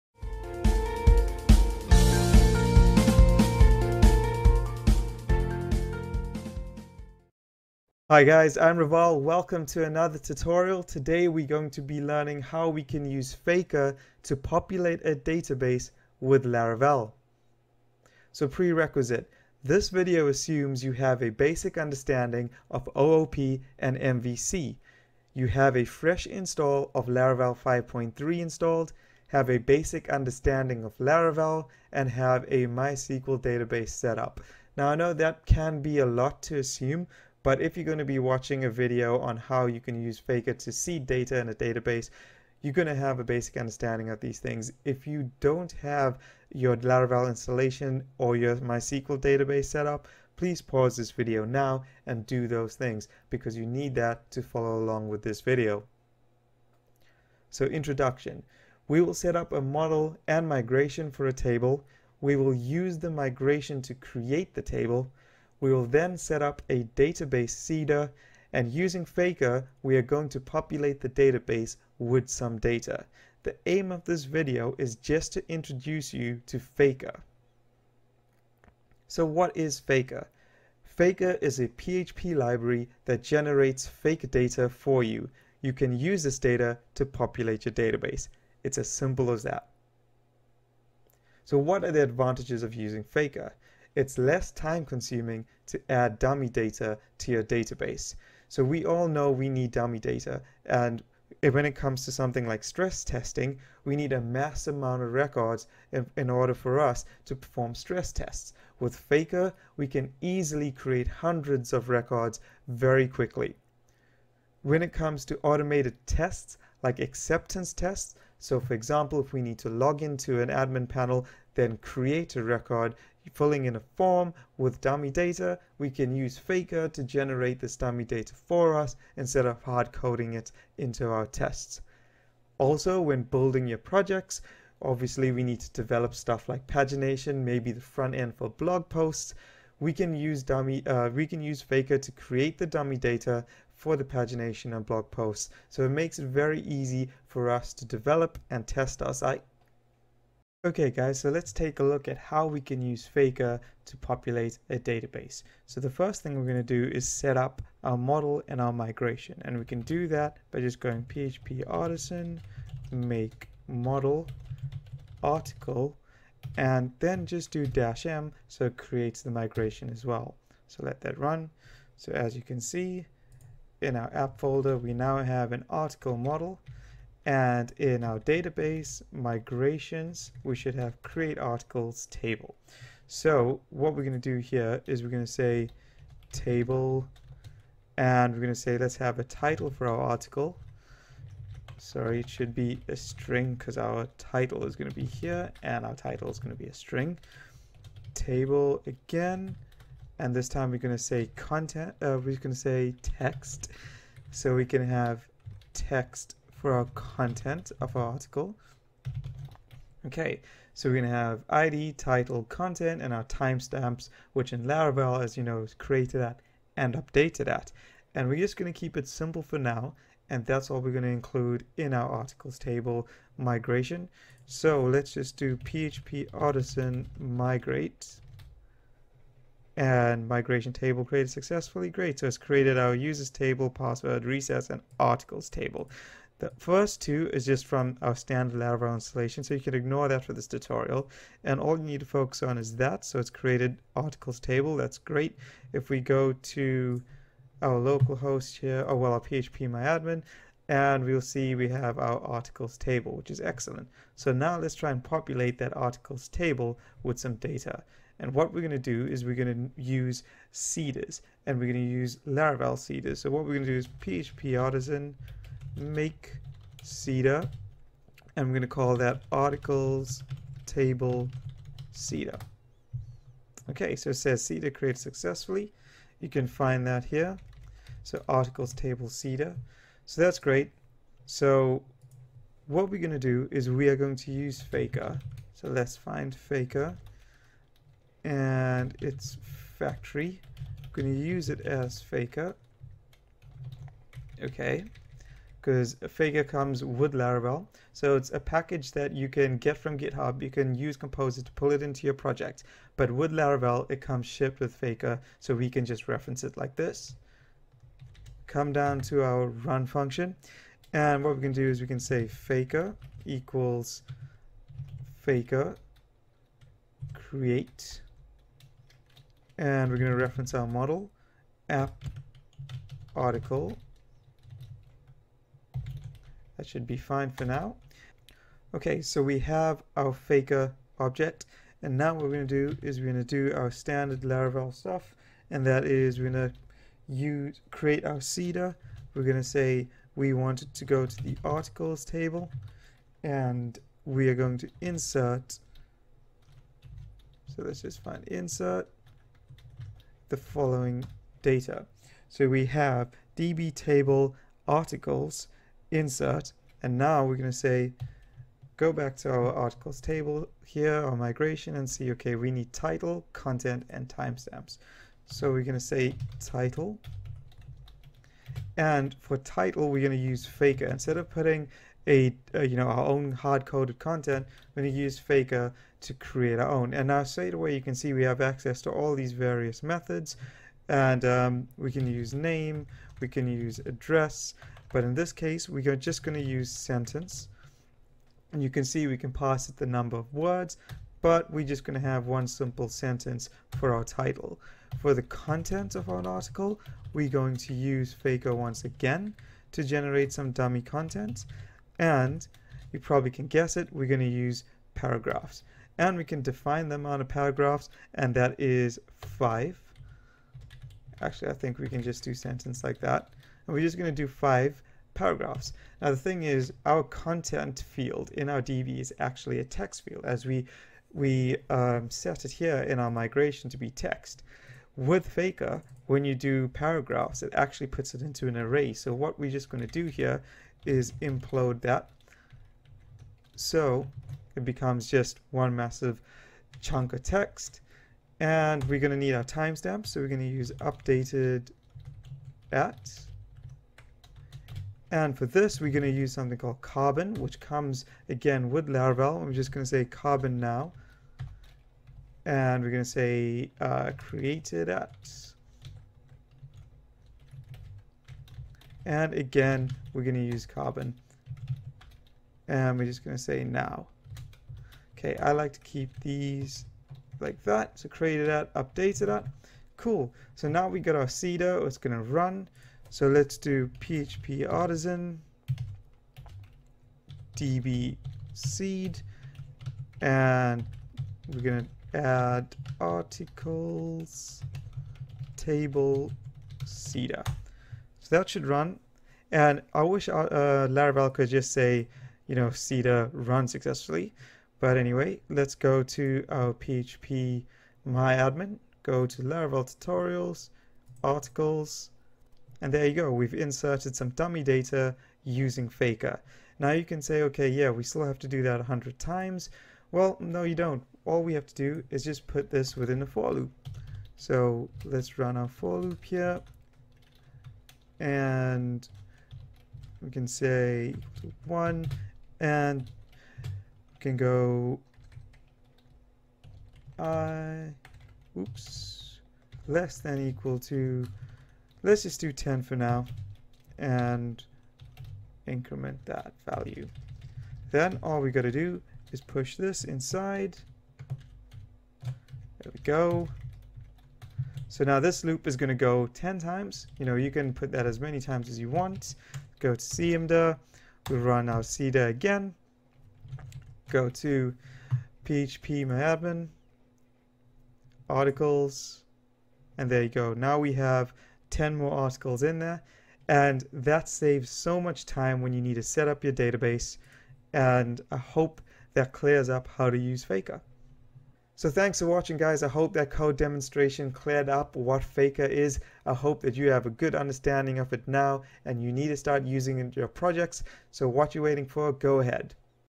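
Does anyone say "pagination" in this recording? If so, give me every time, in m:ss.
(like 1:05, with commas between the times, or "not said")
2:16, 2:24.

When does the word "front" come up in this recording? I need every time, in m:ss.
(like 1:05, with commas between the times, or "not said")
2:17.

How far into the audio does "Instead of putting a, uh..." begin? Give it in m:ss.
6:10.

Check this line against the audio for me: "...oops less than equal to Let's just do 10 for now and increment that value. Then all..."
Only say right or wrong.
right.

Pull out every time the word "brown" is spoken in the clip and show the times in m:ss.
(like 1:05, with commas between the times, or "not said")
not said.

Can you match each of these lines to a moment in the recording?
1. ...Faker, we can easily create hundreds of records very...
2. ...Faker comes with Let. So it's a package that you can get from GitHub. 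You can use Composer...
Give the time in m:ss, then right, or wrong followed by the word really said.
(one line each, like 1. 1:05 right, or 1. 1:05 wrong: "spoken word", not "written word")
1. 1:48 right
2. 4:56 wrong: "Laravel", not "Let".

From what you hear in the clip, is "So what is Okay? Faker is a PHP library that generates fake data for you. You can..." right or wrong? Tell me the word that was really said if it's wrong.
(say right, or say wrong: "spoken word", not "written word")
wrong: "Faker", not "Okay".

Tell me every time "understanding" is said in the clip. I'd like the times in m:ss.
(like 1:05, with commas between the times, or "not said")
0:21, 0:30, 0:43, 9:37.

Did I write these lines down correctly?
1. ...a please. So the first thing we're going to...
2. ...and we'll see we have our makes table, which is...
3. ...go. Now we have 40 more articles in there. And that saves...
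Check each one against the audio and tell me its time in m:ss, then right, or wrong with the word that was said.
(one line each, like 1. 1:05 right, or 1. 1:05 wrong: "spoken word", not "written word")
1. 2:34 wrong: "database", not "please"
2. 4:10 wrong: "articles", not "makes"
3. 9:20 wrong: "10", not "40".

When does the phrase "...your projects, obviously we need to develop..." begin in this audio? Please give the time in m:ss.
2:13.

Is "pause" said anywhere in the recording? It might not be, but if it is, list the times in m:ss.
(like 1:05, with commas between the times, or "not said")
0:50.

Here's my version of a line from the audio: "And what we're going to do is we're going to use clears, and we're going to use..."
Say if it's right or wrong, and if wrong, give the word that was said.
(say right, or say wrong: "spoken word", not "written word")
wrong: "seeders", not "clears".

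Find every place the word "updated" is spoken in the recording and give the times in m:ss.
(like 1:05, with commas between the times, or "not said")
3:36, 7:20, 7:48.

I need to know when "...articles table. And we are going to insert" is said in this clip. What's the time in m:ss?
5:41.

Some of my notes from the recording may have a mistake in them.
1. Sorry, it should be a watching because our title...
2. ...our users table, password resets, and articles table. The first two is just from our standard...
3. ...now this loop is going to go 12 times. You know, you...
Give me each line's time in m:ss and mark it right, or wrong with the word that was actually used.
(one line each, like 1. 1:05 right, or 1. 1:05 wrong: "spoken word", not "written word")
1. 3:11 wrong: "string", not "watching"
2. 3:52 right
3. 9:05 wrong: "10", not "12".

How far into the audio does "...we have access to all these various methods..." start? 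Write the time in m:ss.
6:18.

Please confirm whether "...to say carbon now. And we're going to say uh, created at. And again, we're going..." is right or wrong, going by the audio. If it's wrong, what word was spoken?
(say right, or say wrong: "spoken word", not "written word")
right.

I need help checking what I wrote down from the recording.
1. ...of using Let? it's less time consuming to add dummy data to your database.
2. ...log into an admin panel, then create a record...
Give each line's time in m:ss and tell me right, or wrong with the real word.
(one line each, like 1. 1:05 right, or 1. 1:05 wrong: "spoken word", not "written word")
1. 1:32 wrong: "Faker", not "Let"
2. 1:59 right.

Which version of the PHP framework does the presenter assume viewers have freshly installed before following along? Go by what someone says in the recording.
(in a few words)
Laravel 5.3.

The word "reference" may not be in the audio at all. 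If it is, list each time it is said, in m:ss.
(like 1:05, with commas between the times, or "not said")
5:06, 5:20.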